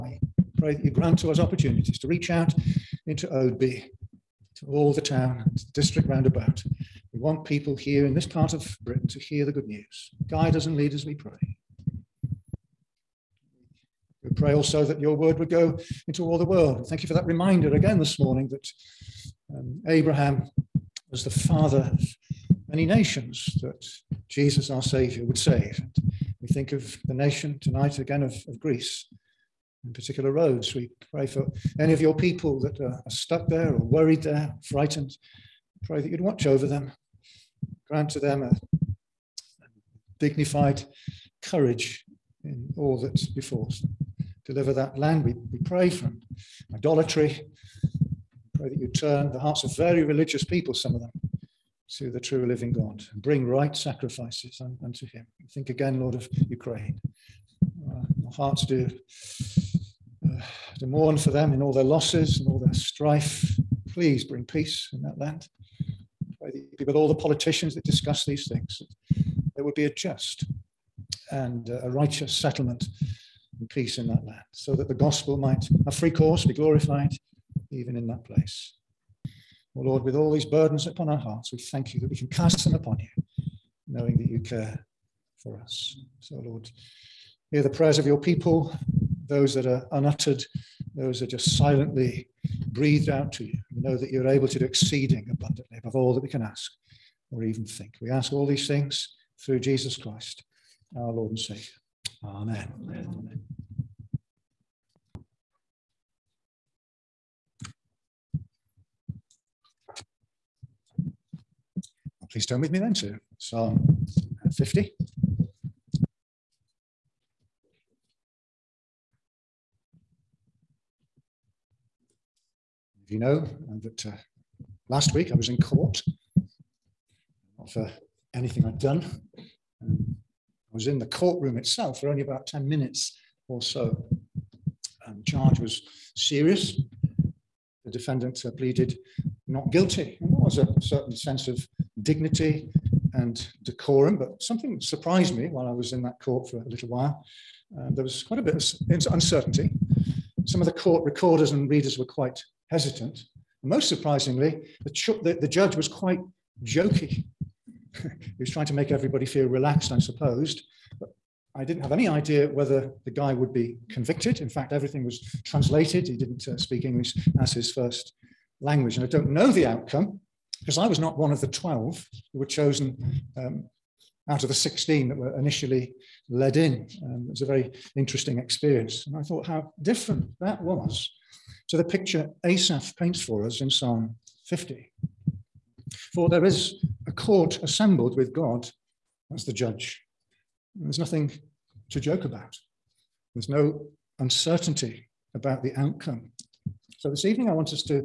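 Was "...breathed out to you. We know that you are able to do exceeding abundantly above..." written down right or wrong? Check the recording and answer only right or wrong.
right.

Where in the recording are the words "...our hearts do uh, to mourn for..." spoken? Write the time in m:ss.
0:58.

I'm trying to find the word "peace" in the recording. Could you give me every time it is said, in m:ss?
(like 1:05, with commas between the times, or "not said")
1:04, 1:13.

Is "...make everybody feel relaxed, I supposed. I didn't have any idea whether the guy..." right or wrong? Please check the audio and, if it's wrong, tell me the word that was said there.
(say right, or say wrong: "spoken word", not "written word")
right.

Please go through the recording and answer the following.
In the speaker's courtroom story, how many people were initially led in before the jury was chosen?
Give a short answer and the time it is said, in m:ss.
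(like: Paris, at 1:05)
16, at 2:54.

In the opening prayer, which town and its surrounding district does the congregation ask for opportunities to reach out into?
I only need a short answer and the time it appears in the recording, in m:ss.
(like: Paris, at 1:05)
Oadby, at 0:03.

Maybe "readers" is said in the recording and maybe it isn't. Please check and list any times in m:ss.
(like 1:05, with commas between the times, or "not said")
2:31.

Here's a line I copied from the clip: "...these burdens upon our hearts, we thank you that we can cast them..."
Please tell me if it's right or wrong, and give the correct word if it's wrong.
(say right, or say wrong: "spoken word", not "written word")
right.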